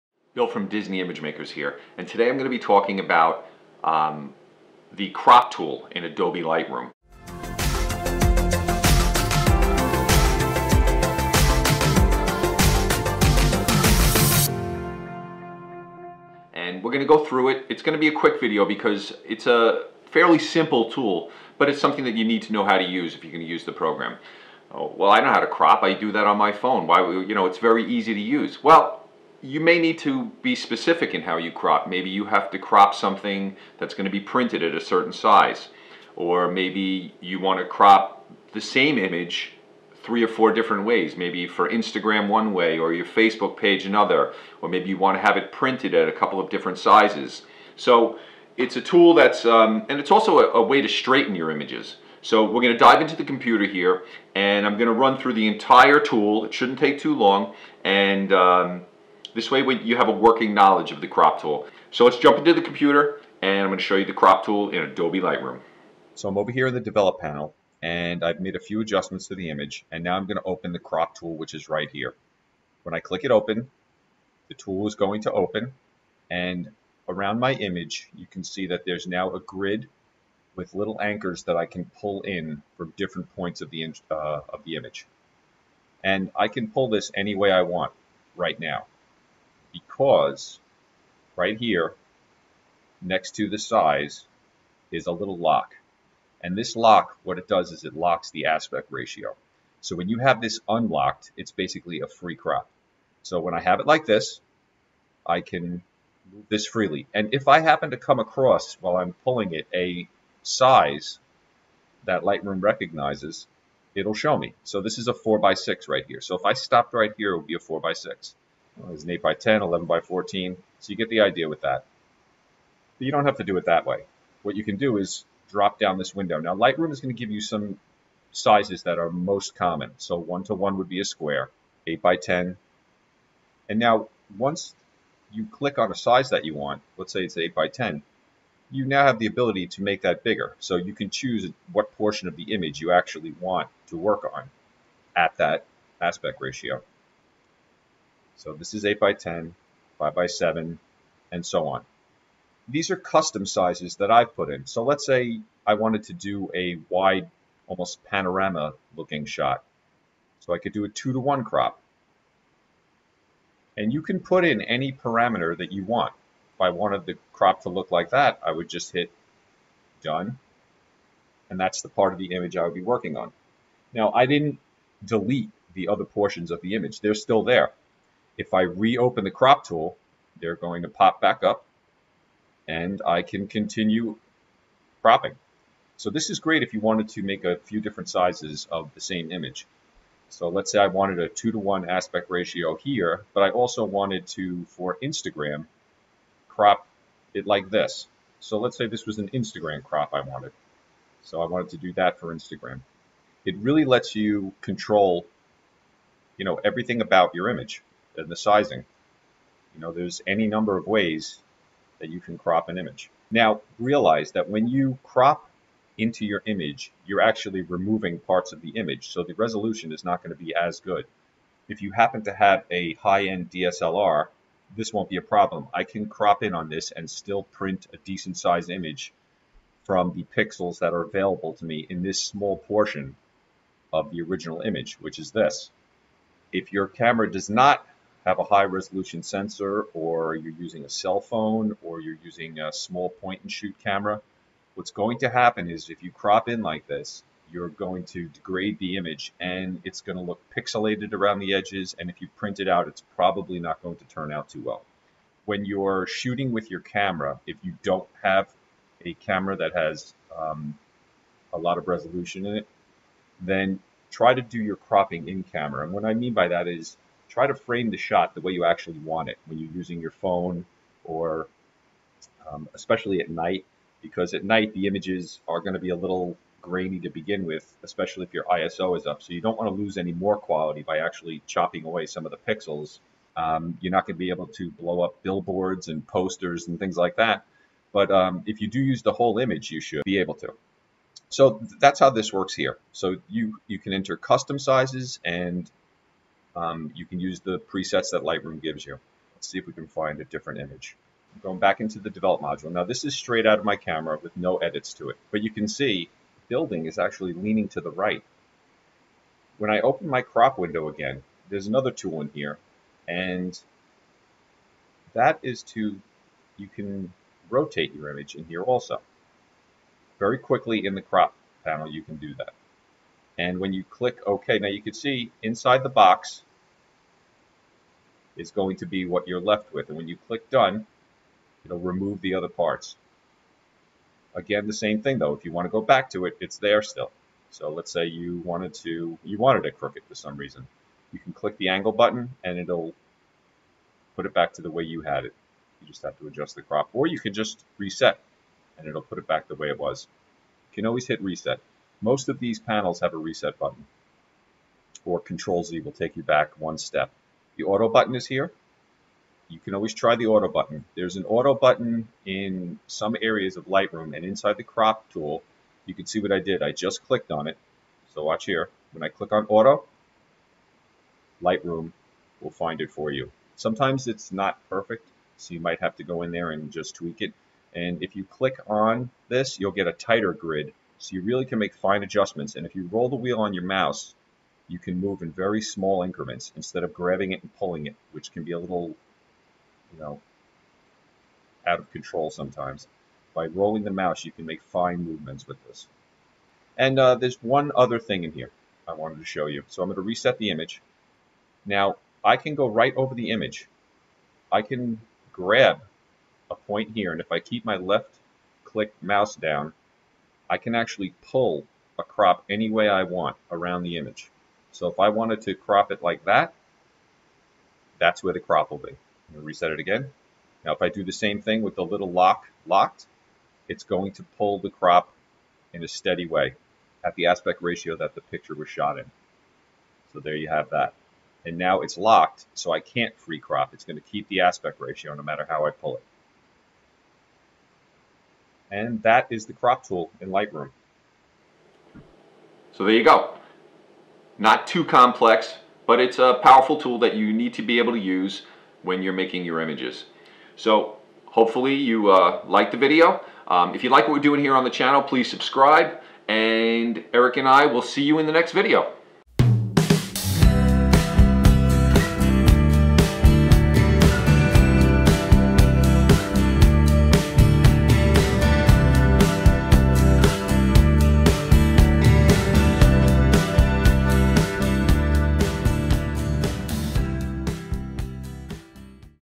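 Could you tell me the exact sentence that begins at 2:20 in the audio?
So you can choose what portion of the image you actually want to work on at that aspect ratio.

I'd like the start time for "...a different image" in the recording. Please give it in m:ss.
5:00.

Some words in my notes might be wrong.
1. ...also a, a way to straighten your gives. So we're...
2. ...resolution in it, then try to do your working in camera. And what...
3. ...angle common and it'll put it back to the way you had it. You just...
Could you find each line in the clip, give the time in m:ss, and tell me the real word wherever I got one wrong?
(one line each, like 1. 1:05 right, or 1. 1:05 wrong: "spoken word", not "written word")
1. 0:50 wrong: "images", not "gives"
2. 4:21 wrong: "cropping", not "working"
3. 5:41 wrong: "button", not "common".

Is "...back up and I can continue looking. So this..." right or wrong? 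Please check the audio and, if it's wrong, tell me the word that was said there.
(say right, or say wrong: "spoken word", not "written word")
wrong: "cropping", not "looking".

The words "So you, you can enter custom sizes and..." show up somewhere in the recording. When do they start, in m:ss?
4:52.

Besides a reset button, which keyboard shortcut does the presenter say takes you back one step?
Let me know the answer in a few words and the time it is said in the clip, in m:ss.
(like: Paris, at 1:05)
Control Z, at 5:55.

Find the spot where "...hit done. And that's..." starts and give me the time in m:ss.
2:48.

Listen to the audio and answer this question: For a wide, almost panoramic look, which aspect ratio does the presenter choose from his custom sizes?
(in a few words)
2 to 1.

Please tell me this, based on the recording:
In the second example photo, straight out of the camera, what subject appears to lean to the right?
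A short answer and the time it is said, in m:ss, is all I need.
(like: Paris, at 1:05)
the building, at 5:06.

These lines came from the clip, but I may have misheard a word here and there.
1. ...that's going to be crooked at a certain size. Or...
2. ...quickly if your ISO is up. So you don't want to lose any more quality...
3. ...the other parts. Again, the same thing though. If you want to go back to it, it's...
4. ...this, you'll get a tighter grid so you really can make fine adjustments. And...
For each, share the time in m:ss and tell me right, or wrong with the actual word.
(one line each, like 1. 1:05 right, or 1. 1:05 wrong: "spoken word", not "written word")
1. 0:33 wrong: "printed", not "crooked"
2. 4:37 wrong: "especially", not "quickly"
3. 5:32 right
4. 6:19 right.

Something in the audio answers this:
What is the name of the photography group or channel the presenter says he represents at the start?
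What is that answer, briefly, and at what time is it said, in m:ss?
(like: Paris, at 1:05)
Disney Image Makers, at 0:00.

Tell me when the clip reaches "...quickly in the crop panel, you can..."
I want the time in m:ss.
5:20.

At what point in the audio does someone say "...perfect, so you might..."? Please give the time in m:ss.
6:14.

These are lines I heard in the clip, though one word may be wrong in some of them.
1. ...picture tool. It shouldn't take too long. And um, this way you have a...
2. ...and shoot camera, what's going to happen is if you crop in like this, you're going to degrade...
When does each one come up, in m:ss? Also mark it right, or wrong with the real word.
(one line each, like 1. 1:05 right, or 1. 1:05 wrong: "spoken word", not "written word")
1. 0:55 wrong: "entire", not "picture"
2. 4:03 right.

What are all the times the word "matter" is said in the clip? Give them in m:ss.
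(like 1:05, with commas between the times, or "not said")
7:15.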